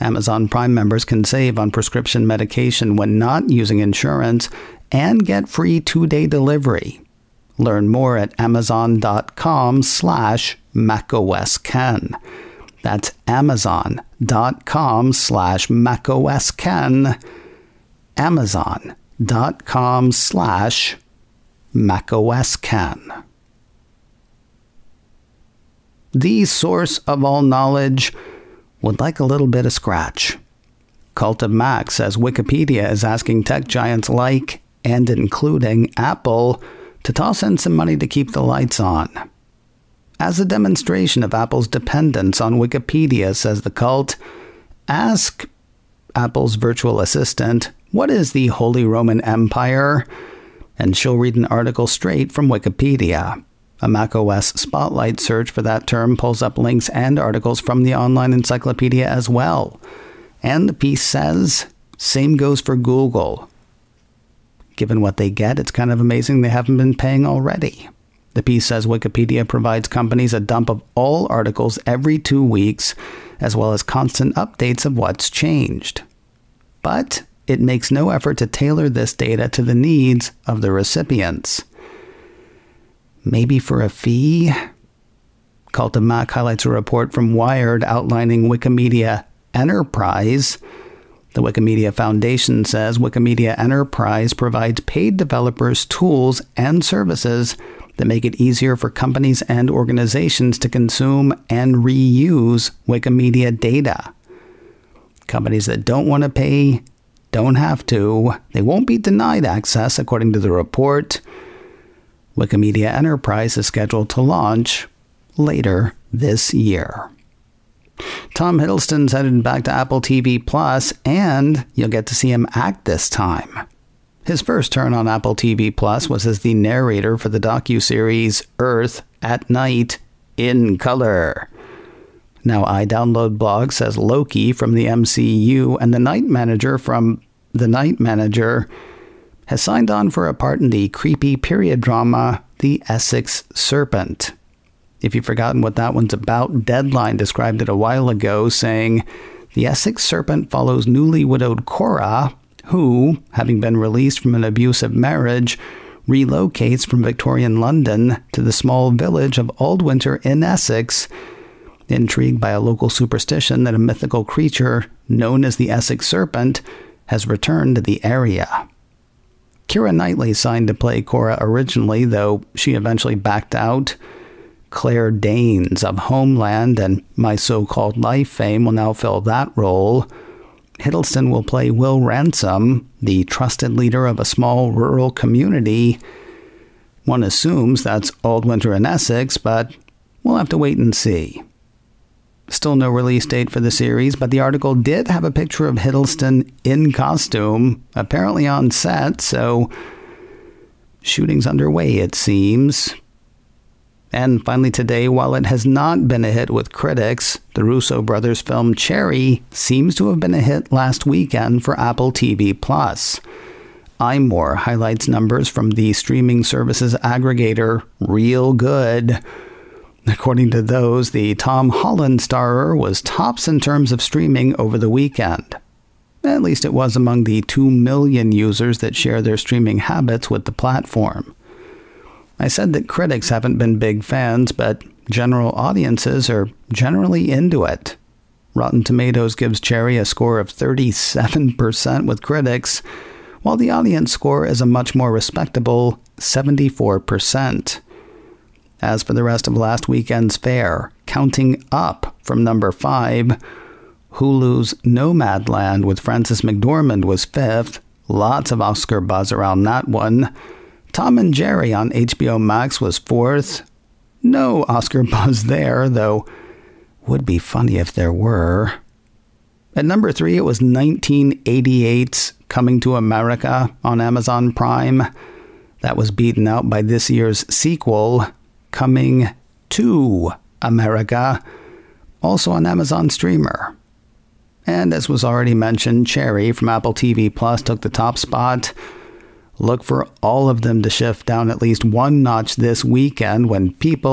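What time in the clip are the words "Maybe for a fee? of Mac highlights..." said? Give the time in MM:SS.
01:23.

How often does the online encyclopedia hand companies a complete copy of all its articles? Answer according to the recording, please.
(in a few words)
every two weeks.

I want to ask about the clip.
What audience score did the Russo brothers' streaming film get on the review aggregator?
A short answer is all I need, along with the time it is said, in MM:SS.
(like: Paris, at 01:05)
74%, at 04:06.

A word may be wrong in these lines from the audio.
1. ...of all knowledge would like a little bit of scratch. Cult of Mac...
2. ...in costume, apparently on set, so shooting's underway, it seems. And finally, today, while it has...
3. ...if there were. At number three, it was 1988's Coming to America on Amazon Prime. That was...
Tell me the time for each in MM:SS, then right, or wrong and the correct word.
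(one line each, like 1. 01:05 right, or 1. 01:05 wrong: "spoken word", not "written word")
1. 00:26 right
2. 03:16 right
3. 04:27 right.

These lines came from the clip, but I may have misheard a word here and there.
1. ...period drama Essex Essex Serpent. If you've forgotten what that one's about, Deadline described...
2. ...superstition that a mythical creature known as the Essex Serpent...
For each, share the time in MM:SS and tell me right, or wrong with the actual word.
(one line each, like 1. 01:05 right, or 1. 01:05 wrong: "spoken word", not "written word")
1. 02:21 wrong: "The", not "Essex"
2. 02:42 right.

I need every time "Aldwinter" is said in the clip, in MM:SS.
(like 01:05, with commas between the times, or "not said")
02:39, 03:08.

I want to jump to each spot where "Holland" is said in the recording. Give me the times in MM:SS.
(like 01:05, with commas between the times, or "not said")
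03:41.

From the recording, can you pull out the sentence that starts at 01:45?
Companies that don't want to pay don't have to.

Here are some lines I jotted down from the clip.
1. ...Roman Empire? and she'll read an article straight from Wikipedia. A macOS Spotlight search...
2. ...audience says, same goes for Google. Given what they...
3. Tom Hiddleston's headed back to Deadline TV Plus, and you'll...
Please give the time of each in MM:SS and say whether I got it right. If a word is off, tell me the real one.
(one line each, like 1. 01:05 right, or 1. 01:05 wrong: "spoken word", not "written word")
1. 00:48 right
2. 01:00 wrong: "piece", not "audience"
3. 01:58 wrong: "Apple", not "Deadline".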